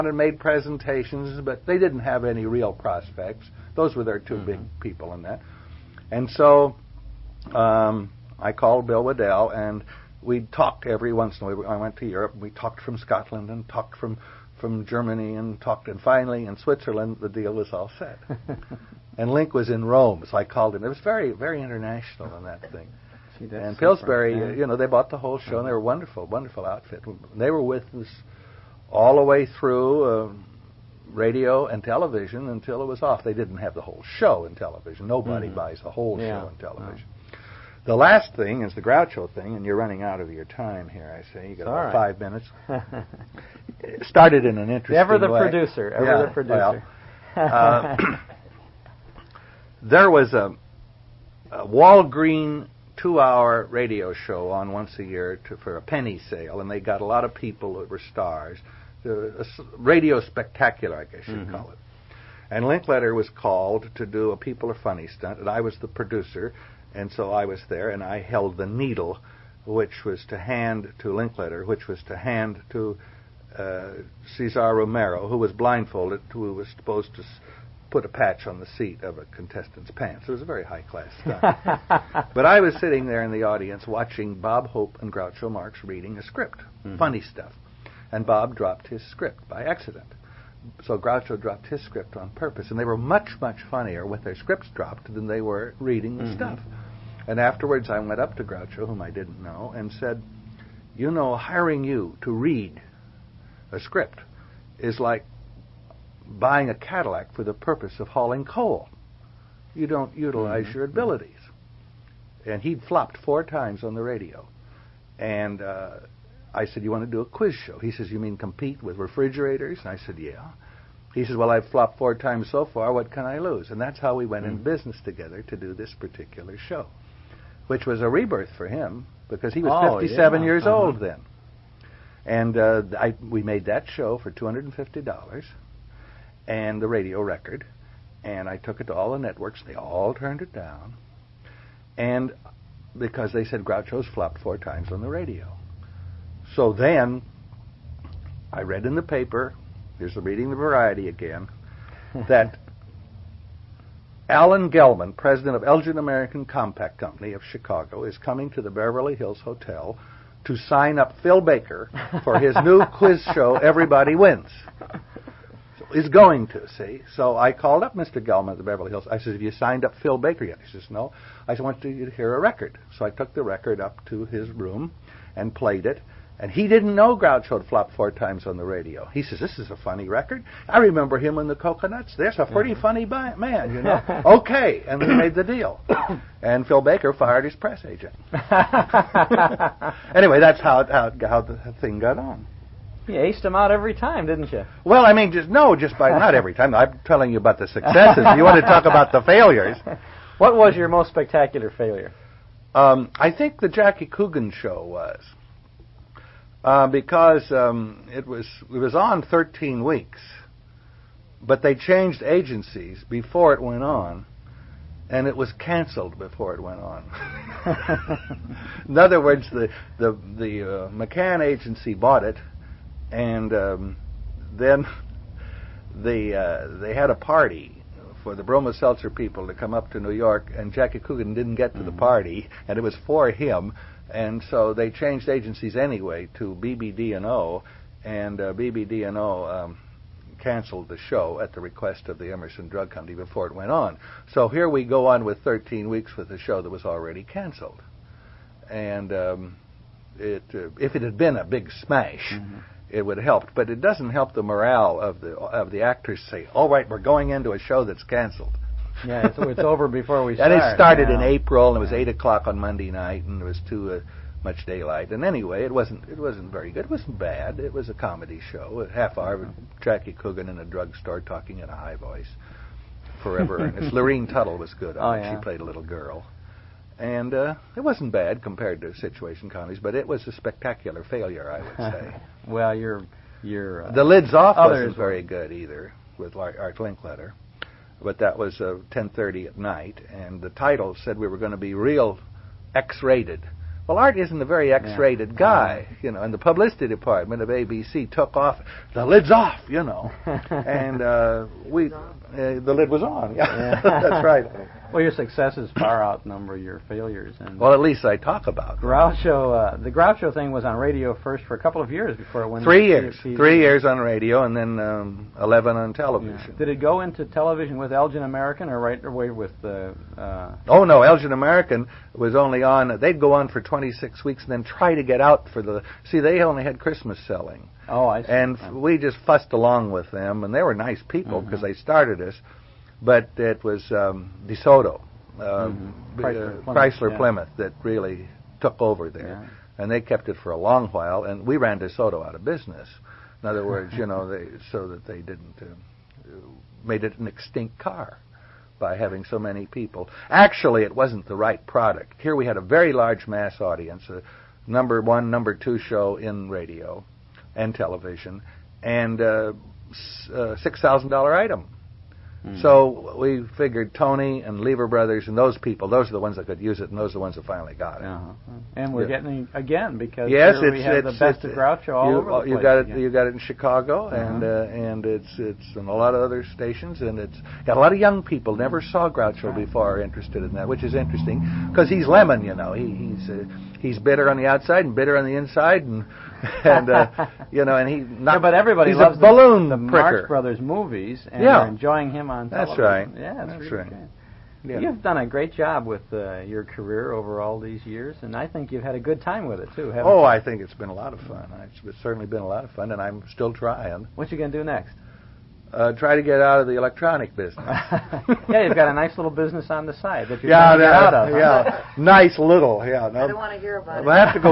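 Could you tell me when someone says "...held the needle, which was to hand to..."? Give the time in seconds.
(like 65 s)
68 s.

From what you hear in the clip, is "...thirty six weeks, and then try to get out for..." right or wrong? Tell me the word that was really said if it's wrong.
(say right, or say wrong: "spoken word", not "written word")
wrong: "twenty", not "thirty".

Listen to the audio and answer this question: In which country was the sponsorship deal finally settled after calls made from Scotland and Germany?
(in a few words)
Switzerland.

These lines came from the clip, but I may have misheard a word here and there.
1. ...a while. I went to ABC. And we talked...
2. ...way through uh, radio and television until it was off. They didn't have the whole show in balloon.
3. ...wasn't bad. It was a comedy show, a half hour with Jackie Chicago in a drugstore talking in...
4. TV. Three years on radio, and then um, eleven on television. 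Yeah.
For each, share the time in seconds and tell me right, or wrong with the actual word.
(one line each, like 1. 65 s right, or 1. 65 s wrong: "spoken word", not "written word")
1. 11 s wrong: "Europe", not "ABC"
2. 29 s wrong: "television", not "balloon"
3. 266 s wrong: "Coogan", not "Chicago"
4. 313 s right.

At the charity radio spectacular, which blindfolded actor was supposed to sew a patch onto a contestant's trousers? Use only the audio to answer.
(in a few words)
Cesar Romero.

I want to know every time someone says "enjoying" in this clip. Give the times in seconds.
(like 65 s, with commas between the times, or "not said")
391 s.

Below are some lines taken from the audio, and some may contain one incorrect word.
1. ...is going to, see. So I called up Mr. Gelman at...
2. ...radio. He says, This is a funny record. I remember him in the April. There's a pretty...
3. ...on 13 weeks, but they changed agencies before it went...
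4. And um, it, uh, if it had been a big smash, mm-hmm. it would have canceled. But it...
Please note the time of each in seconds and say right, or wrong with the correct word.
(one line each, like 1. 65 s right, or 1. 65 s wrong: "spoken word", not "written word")
1. 165 s right
2. 178 s wrong: "Cocoanuts", not "April"
3. 208 s right
4. 248 s wrong: "helped", not "canceled".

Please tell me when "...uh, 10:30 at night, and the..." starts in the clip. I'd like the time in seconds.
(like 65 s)
288 s.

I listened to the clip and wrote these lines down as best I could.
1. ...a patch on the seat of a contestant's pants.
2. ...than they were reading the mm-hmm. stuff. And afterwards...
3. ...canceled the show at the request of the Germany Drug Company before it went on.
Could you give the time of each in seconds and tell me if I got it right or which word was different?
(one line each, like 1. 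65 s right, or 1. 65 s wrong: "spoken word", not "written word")
1. 78 s right
2. 95 s right
3. 240 s wrong: "Emerson", not "Germany".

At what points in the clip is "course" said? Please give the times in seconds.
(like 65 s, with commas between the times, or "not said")
not said.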